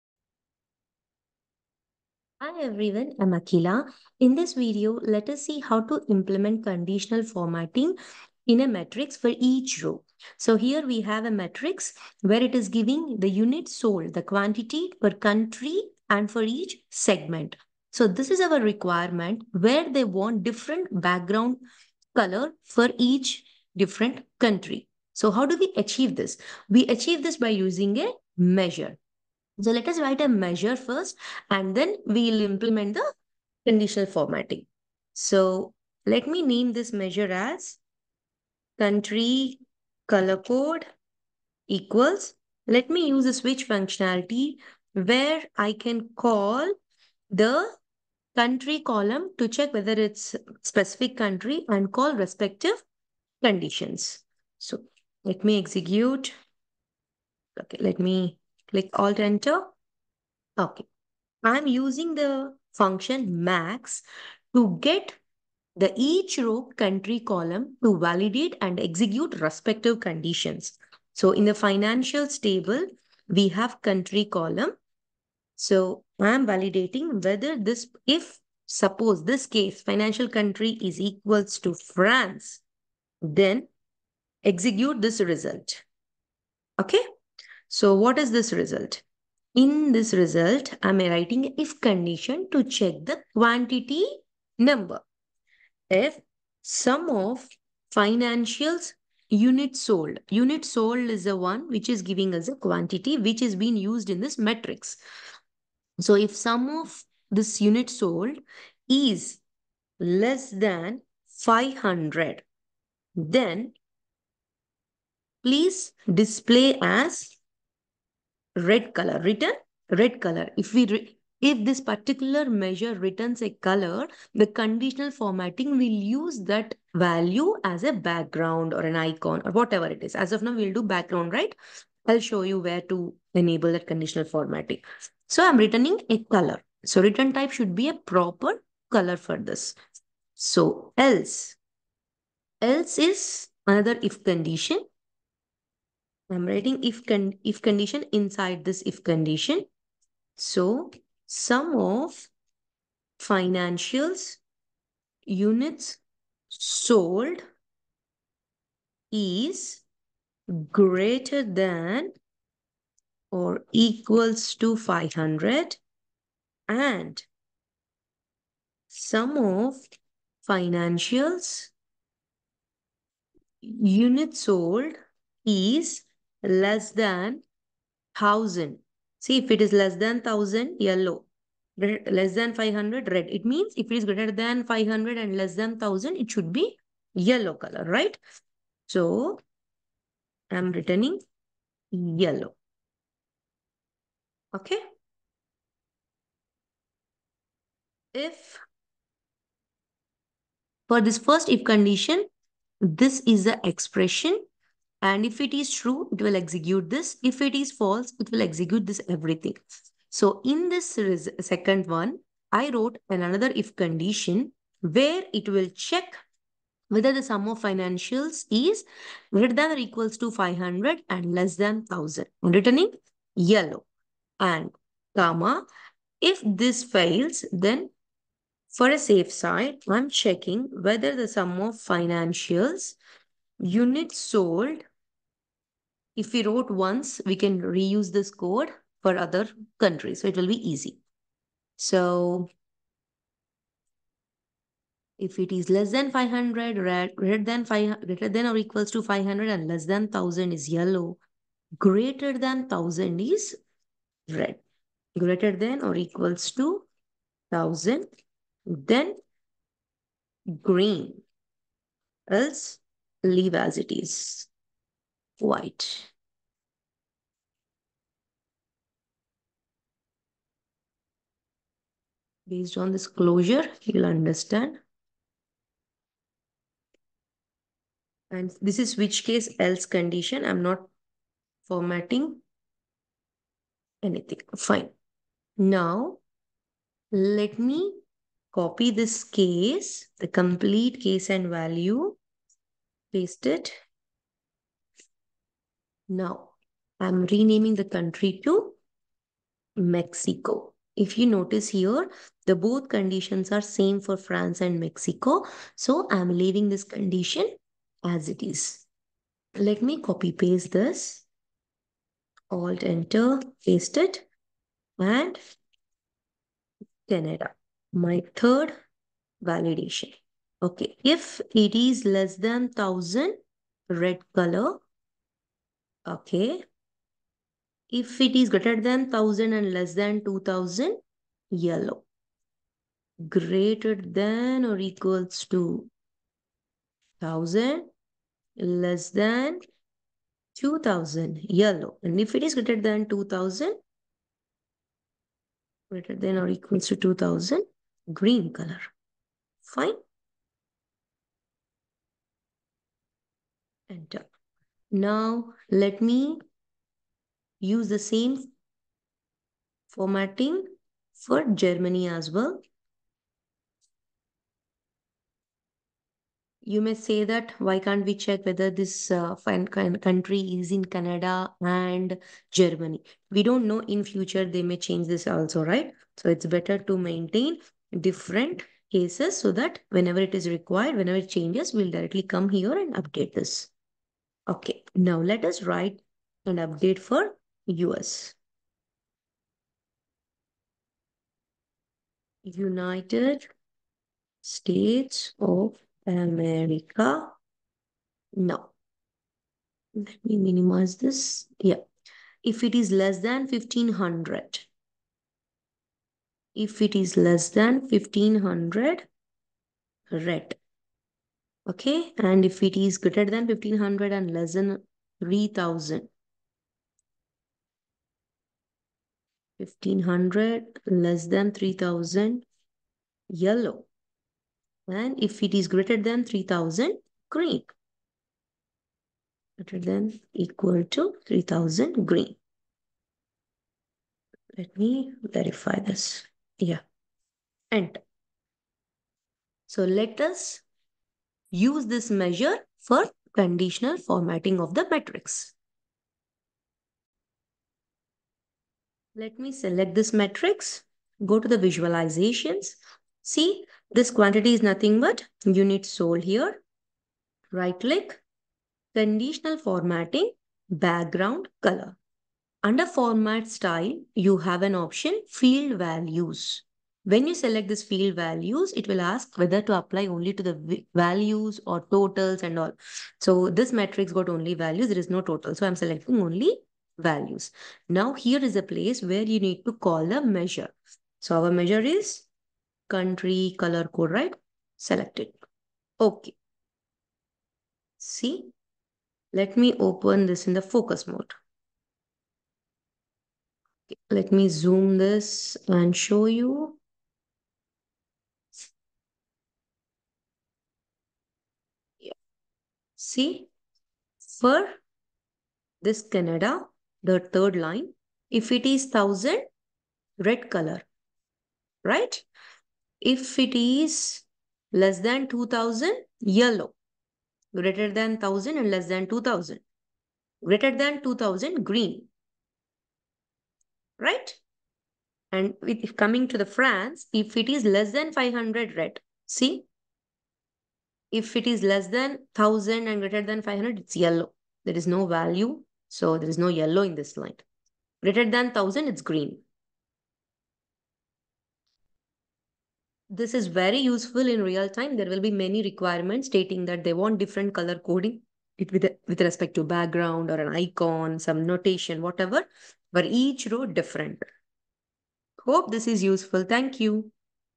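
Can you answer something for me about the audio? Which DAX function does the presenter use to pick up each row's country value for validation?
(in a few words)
max.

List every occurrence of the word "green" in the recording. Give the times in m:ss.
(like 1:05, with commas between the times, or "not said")
4:20, 5:48, 7:07, 7:12, 8:41, 8:59.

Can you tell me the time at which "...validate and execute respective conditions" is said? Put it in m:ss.
1:07.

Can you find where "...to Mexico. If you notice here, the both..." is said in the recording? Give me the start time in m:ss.
4:58.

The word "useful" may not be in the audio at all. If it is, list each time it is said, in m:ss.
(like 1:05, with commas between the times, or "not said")
9:03, 9:16.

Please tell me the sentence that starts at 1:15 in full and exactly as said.
So I'm validating whether this, if suppose this case, financial country is equals to France, then execute this result.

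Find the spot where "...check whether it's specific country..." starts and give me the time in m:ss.
0:49.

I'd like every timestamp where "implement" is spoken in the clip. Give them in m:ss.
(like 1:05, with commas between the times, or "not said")
0:06, 0:32.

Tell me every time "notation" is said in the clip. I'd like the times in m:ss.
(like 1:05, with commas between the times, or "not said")
9:11.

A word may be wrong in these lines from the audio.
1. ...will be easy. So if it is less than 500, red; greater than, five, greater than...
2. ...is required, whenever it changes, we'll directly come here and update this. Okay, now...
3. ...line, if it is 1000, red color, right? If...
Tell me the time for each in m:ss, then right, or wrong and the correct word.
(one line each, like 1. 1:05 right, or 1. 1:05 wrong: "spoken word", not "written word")
1. 4:00 right
2. 6:20 right
3. 8:27 right.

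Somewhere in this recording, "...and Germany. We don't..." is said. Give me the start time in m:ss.
6:11.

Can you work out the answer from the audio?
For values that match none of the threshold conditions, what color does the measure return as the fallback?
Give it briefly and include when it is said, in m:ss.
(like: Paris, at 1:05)
white, at 4:25.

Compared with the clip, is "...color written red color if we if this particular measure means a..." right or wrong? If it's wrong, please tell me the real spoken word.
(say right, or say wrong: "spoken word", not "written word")
wrong: "returns", not "means".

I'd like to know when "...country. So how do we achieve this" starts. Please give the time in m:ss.
0:24.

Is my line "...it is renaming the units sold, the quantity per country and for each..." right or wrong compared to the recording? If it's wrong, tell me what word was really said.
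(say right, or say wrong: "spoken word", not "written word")
wrong: "giving", not "renaming".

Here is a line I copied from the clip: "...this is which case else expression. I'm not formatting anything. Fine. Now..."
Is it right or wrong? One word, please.
wrong.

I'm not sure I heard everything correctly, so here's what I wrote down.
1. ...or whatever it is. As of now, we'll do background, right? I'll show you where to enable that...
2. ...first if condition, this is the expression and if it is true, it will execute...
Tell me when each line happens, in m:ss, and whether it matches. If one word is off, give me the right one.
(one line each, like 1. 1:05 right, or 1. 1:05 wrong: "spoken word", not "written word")
1. 2:09 right
2. 3:21 right.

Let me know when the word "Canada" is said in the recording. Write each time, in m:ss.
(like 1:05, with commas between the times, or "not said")
5:17, 6:10, 8:26.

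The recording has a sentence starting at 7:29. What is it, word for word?
Let me select this matrix, go to the visualizations.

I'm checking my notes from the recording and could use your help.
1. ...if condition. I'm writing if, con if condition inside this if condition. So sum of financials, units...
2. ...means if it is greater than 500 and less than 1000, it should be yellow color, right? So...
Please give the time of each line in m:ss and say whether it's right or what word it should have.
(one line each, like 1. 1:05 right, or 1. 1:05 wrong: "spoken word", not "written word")
1. 2:24 right
2. 3:03 right.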